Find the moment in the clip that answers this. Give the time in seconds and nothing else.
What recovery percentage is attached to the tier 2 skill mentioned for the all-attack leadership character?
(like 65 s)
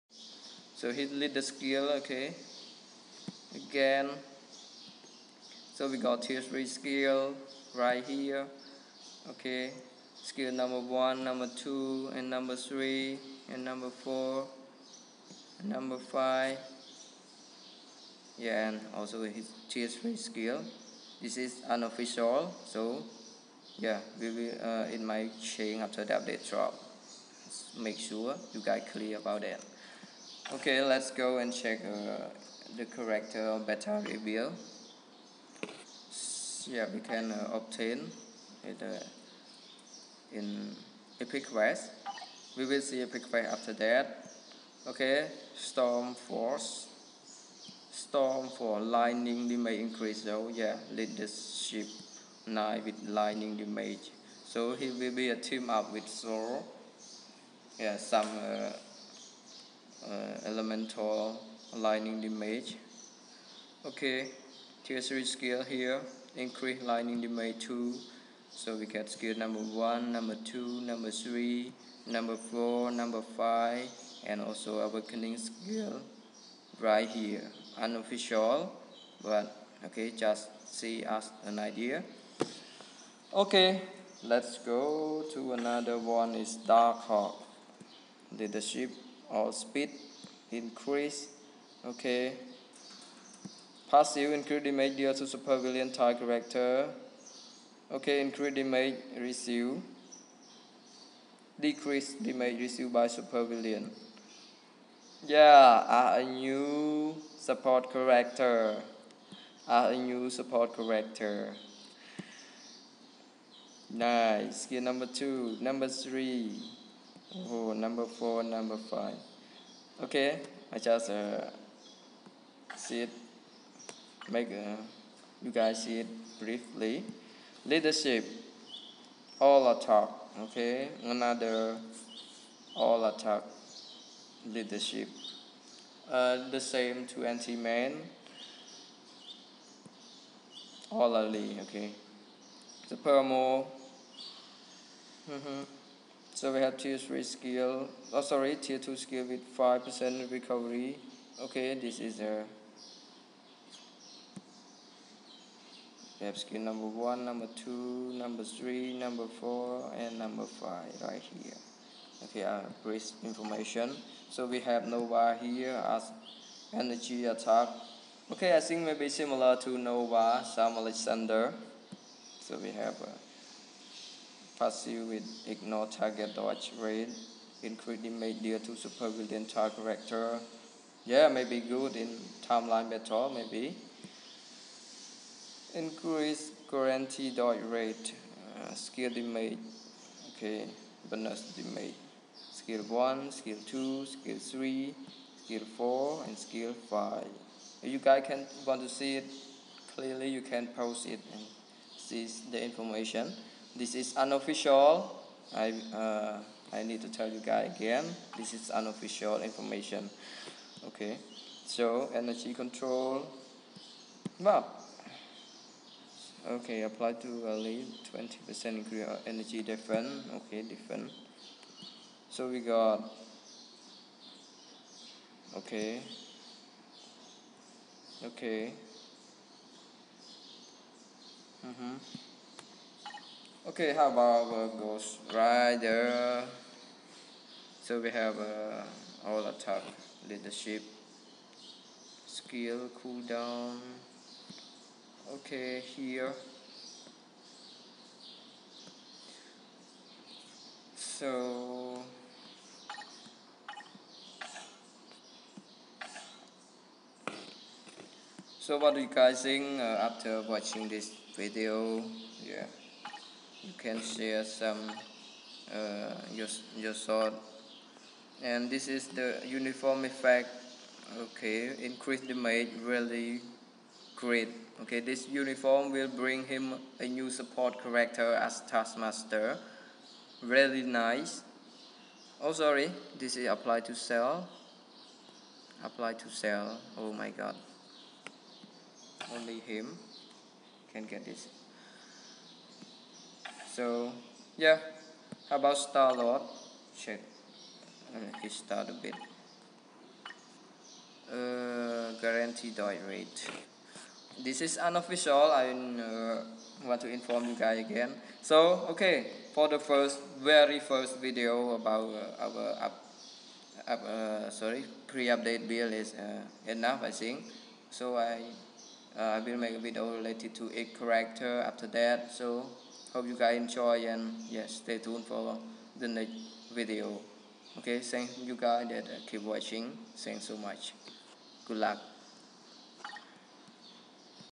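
149 s.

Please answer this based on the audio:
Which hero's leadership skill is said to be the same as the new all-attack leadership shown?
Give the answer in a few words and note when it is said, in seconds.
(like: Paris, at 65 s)
Ant-Man, at 137 s.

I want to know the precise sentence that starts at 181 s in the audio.
Yeah, maybe good in timeline battle, maybe.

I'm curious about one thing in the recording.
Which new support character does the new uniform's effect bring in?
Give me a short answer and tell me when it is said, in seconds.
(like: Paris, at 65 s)
Taskmaster, at 278 s.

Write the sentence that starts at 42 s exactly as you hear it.
We will see Epic Quest after that.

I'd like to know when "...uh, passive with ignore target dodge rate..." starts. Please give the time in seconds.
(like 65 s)
173 s.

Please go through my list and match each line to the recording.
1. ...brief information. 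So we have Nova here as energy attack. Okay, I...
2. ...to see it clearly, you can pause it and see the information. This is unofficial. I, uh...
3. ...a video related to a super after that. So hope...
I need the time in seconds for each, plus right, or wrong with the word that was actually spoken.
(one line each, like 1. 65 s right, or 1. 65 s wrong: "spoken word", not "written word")
1. 162 s right
2. 198 s right
3. 319 s wrong: "character", not "super".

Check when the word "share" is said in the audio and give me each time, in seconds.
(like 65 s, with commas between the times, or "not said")
264 s.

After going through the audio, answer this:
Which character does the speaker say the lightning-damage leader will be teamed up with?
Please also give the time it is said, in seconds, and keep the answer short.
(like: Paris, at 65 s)
Zoro, at 56 s.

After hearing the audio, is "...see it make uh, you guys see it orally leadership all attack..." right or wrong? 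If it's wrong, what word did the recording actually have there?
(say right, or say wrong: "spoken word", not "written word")
wrong: "briefly", not "orally".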